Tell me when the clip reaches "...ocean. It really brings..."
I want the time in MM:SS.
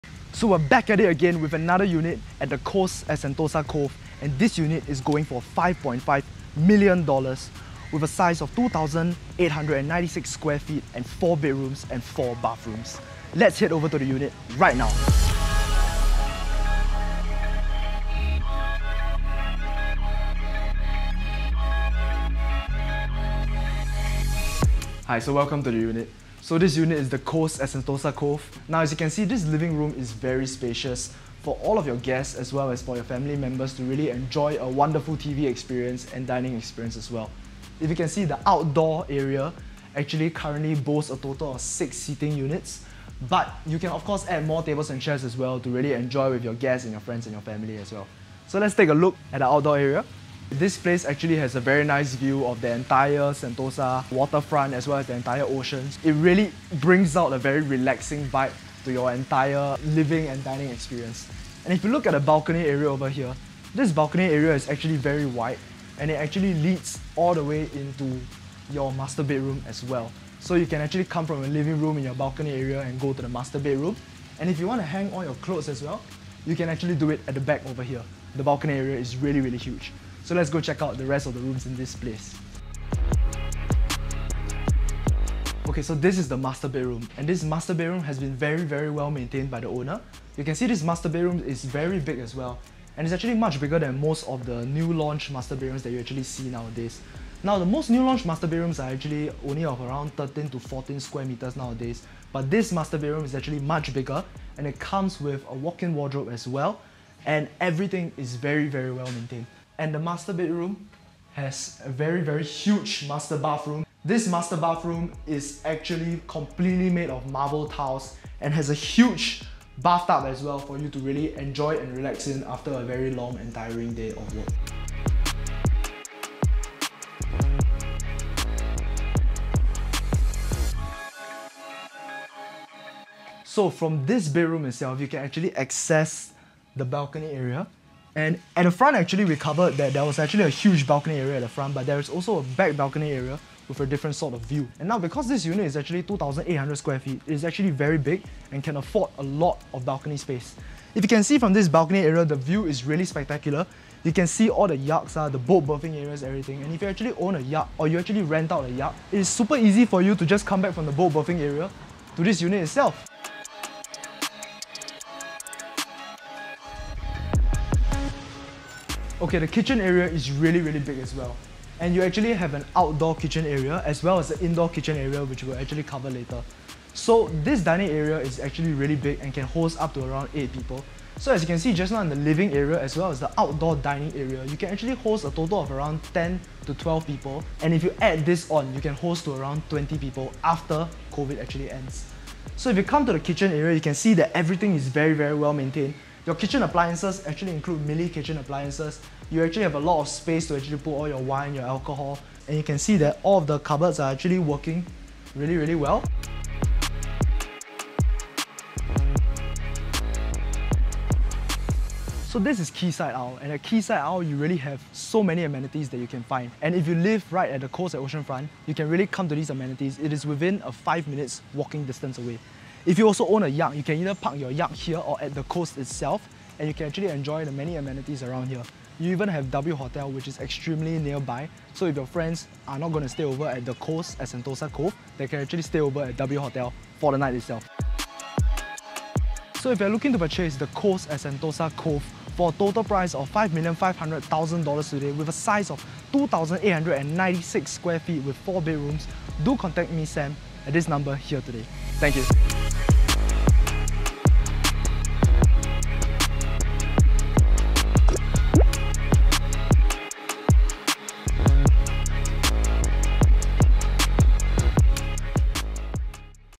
00:55.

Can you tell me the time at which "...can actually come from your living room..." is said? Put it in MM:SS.
01:10.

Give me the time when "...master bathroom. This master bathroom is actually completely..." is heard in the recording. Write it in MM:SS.
01:53.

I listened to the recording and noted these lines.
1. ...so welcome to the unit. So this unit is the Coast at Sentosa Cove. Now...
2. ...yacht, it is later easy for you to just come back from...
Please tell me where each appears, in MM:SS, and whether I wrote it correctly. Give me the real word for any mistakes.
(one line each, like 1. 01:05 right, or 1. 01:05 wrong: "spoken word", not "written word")
1. 00:25 right
2. 02:38 wrong: "super", not "later".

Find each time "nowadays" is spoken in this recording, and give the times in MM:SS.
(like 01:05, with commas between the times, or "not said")
01:36, 01:41.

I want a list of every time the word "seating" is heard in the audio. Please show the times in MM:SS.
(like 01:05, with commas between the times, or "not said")
00:41.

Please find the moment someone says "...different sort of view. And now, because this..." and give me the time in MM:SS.
02:23.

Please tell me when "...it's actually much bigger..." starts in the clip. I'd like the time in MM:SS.
01:33.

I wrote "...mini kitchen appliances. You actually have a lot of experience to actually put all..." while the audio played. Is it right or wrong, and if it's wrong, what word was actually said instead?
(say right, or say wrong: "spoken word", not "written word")
wrong: "space", not "experience".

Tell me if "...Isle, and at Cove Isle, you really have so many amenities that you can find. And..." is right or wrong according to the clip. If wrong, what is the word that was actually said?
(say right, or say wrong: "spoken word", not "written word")
wrong: "Quayside", not "Cove".